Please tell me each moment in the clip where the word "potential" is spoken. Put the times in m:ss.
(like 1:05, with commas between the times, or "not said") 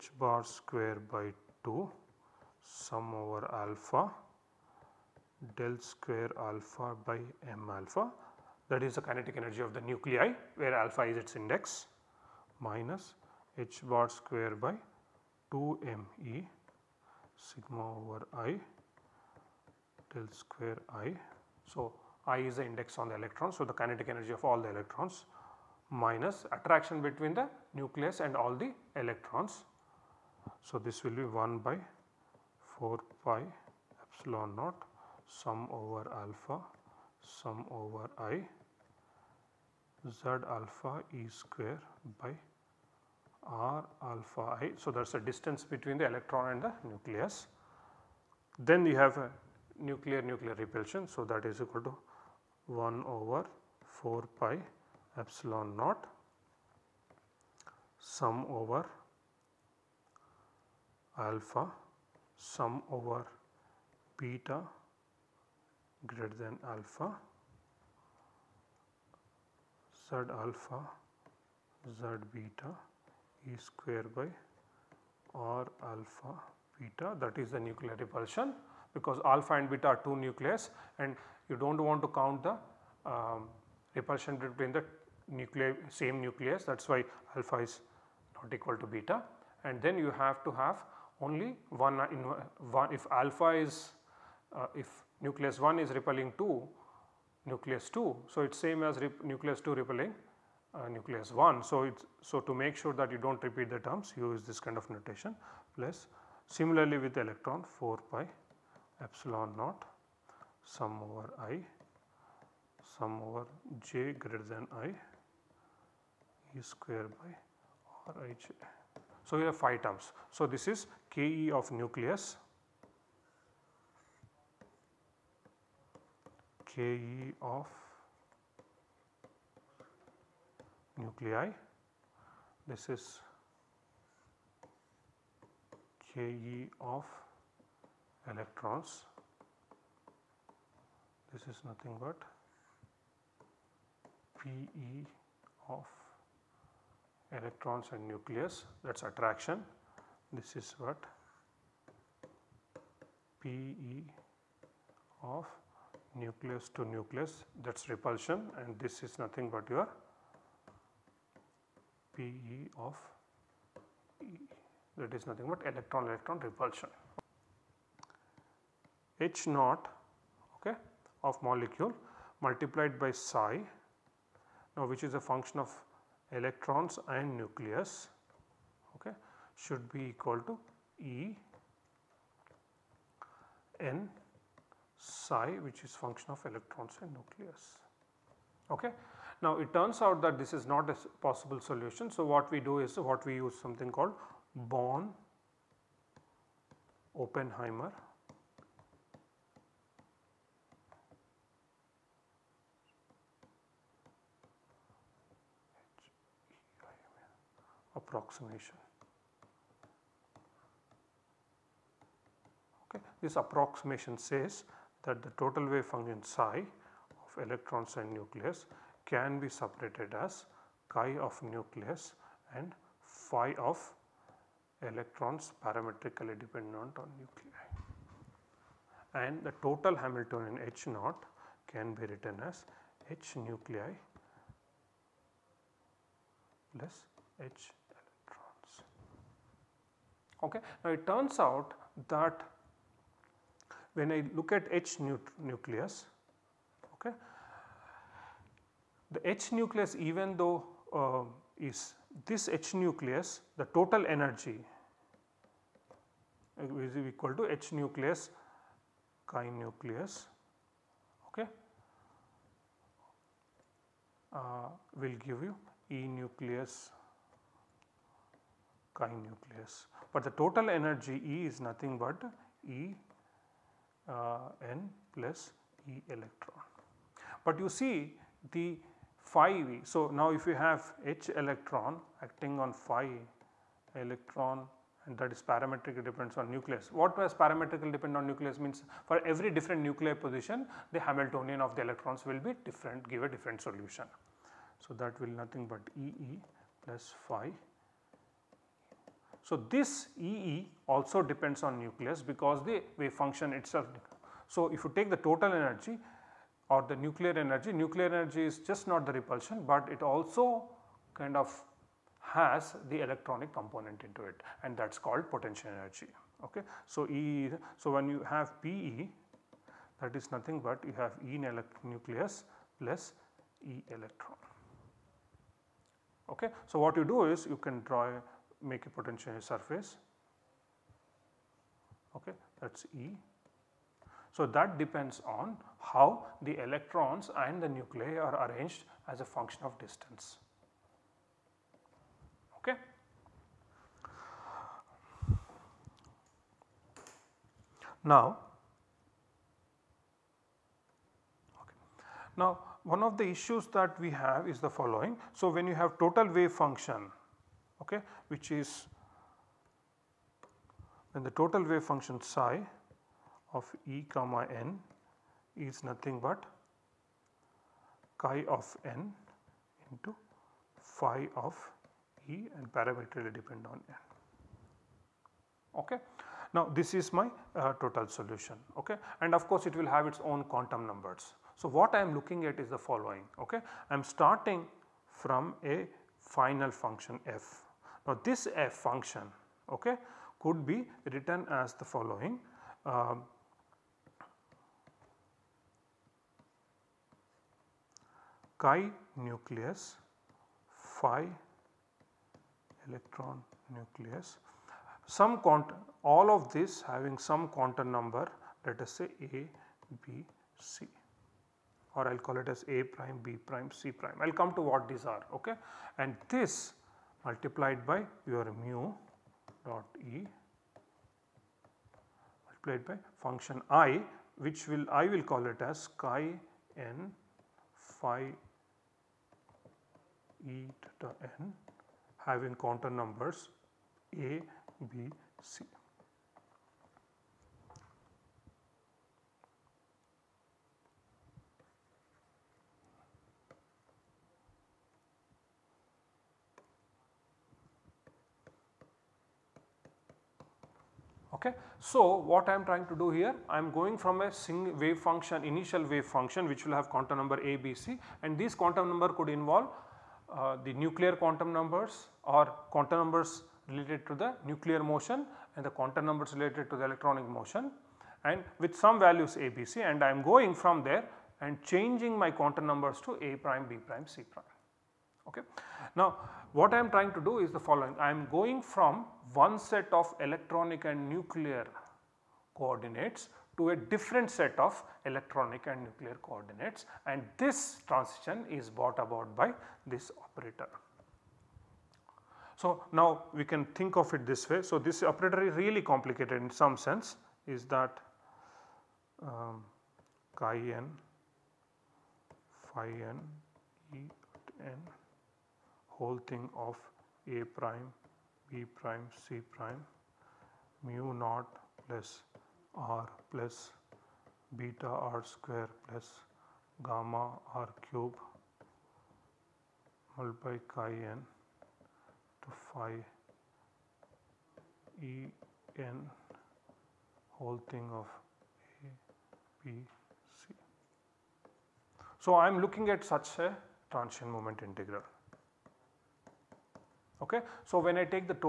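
5:15, 5:28.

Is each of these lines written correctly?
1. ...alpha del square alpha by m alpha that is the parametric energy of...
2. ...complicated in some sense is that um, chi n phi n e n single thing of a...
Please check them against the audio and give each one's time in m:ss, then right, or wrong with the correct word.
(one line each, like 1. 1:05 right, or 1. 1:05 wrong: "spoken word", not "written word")
1. 0:03 wrong: "kinetic", not "parametric"
2. 8:15 wrong: "whole", not "single".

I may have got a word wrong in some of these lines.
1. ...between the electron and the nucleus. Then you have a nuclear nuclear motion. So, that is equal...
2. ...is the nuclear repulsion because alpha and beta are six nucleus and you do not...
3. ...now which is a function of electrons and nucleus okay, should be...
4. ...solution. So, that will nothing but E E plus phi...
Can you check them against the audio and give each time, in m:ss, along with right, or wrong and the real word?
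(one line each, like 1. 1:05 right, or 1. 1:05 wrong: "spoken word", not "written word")
1. 0:45 wrong: "repulsion", not "motion"
2. 1:17 wrong: "two", not "six"
3. 2:54 right
4. 4:53 right.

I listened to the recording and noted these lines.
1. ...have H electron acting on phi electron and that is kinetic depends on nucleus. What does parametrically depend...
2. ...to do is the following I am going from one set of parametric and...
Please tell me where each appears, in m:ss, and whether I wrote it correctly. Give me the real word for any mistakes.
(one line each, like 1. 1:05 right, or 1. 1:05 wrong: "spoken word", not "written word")
1. 4:40 wrong: "parametric", not "kinetic"
2. 7:57 wrong: "electronic", not "parametric".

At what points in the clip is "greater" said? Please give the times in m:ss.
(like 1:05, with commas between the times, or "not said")
1:06, 1:54.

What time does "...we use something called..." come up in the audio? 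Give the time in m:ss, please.
3:13.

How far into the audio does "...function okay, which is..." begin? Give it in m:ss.
5:56.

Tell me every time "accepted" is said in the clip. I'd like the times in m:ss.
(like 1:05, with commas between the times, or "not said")
not said.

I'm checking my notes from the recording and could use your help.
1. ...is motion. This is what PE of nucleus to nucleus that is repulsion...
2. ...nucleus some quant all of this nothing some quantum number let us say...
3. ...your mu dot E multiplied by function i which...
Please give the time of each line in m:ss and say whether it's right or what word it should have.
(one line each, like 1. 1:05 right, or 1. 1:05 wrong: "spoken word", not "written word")
1. 2:28 wrong: "attraction", not "motion"
2. 6:43 wrong: "having", not "nothing"
3. 6:58 right.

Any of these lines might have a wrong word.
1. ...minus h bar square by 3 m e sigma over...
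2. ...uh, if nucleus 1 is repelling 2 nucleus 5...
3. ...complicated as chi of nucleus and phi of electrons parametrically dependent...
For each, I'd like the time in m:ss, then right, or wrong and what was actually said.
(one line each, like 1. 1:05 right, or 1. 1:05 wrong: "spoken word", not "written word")
1. 0:12 wrong: "2", not "3"
2. 1:34 wrong: "2", not "5"
3. 3:39 wrong: "separated", not "complicated".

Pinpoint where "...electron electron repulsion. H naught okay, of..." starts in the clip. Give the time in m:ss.
2:45.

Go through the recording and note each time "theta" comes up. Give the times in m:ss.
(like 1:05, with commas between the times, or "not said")
7:10.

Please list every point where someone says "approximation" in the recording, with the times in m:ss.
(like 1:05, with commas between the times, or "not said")
3:28, 3:33.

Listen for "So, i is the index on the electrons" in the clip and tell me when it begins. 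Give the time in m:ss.
0:21.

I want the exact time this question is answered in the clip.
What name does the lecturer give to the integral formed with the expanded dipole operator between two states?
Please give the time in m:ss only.
8:53.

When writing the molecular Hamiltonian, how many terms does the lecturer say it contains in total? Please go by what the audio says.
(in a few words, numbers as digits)
5.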